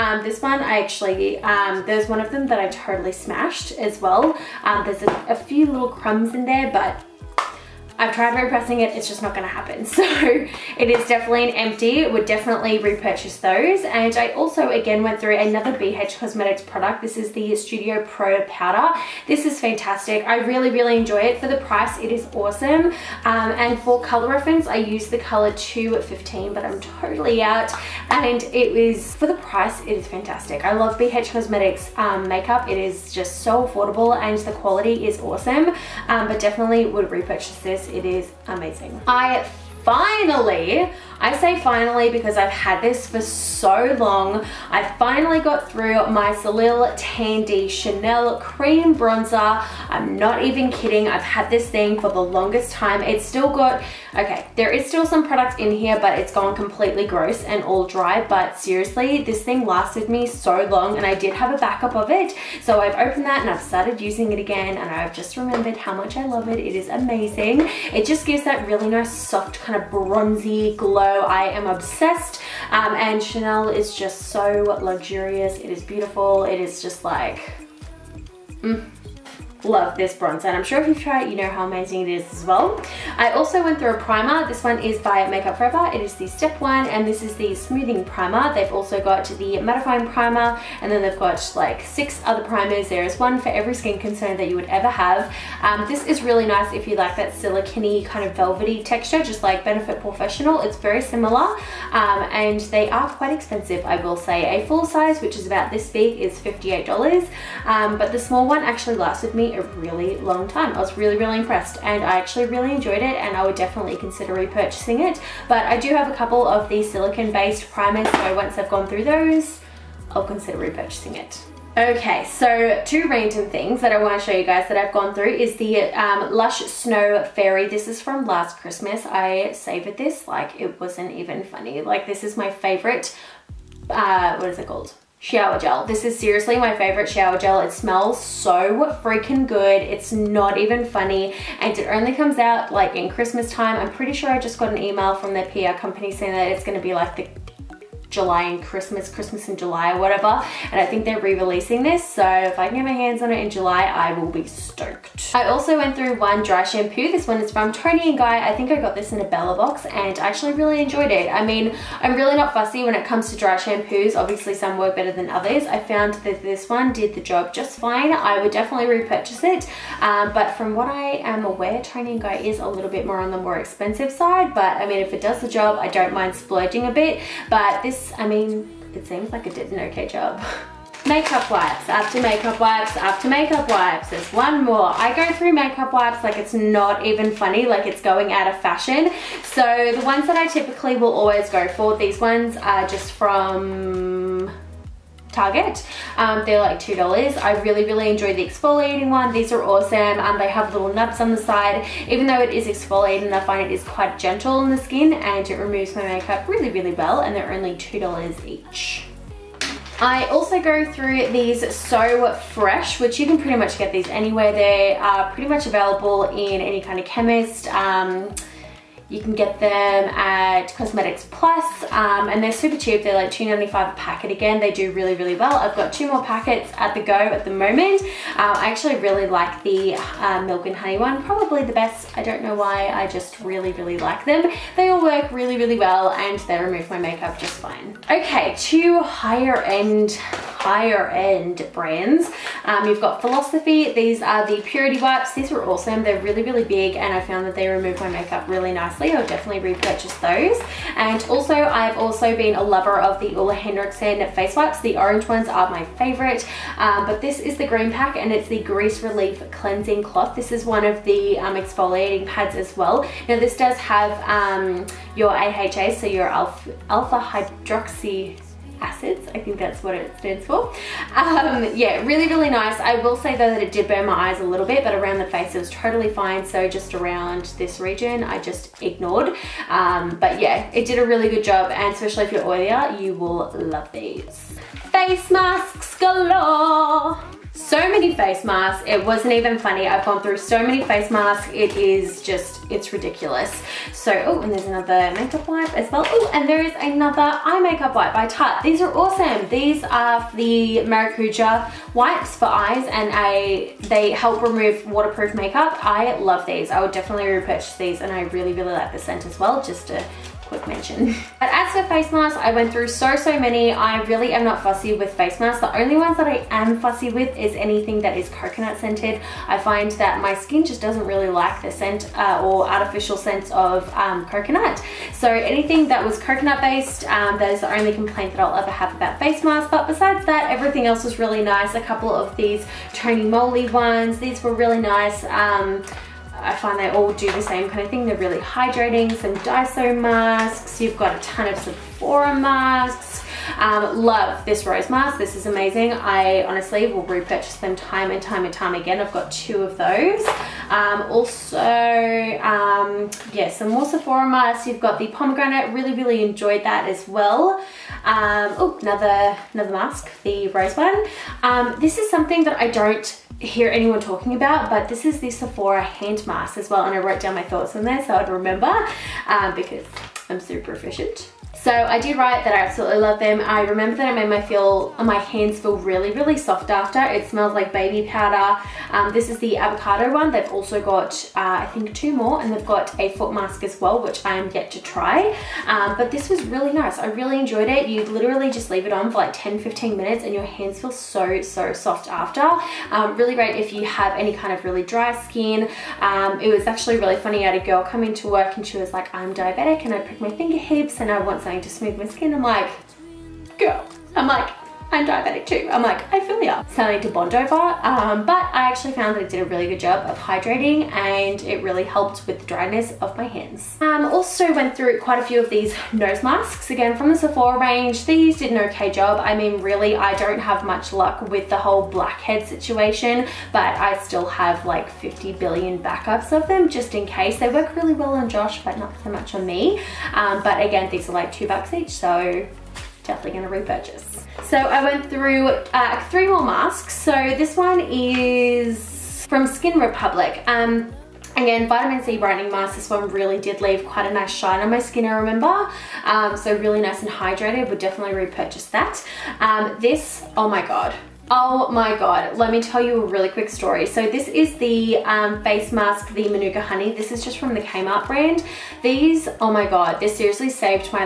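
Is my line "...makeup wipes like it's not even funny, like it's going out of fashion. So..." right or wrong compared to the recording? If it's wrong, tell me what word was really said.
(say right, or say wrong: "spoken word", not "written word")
right.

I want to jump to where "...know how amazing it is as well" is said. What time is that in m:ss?
1:21.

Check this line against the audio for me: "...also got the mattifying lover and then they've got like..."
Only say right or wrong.
wrong.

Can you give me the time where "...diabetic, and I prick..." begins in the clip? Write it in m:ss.
6:39.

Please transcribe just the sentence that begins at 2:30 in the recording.
And I think they're re-releasing this.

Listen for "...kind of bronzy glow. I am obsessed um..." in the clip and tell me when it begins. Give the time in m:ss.
1:09.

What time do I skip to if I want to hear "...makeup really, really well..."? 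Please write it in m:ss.
3:26.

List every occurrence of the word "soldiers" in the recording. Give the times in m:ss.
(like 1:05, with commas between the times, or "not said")
not said.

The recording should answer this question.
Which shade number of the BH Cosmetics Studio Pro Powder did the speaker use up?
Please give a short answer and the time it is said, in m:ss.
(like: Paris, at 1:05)
215, at 0:25.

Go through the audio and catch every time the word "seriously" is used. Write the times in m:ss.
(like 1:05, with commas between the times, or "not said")
0:58, 2:16, 7:40.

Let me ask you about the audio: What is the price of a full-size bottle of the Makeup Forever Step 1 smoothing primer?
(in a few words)
$58.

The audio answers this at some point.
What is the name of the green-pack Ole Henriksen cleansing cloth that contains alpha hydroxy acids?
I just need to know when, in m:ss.
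4:18.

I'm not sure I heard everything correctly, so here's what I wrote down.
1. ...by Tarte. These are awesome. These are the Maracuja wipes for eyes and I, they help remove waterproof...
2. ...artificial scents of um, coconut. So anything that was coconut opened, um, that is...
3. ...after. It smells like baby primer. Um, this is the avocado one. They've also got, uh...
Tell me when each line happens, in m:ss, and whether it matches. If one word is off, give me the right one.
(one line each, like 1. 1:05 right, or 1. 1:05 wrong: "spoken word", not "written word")
1. 4:58 right
2. 5:22 wrong: "based", not "opened"
3. 6:16 wrong: "powder", not "primer".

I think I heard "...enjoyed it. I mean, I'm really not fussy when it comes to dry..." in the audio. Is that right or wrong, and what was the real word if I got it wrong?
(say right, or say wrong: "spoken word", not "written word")
right.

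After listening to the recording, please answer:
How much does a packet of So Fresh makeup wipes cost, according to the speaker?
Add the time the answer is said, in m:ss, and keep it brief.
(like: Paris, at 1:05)
$2.95, at 3:43.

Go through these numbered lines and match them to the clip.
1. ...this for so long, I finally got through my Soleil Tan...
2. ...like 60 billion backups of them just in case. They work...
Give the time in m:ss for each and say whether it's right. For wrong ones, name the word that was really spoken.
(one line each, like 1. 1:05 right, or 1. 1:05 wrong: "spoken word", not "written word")
1. 0:42 right
2. 7:04 wrong: "50", not "60".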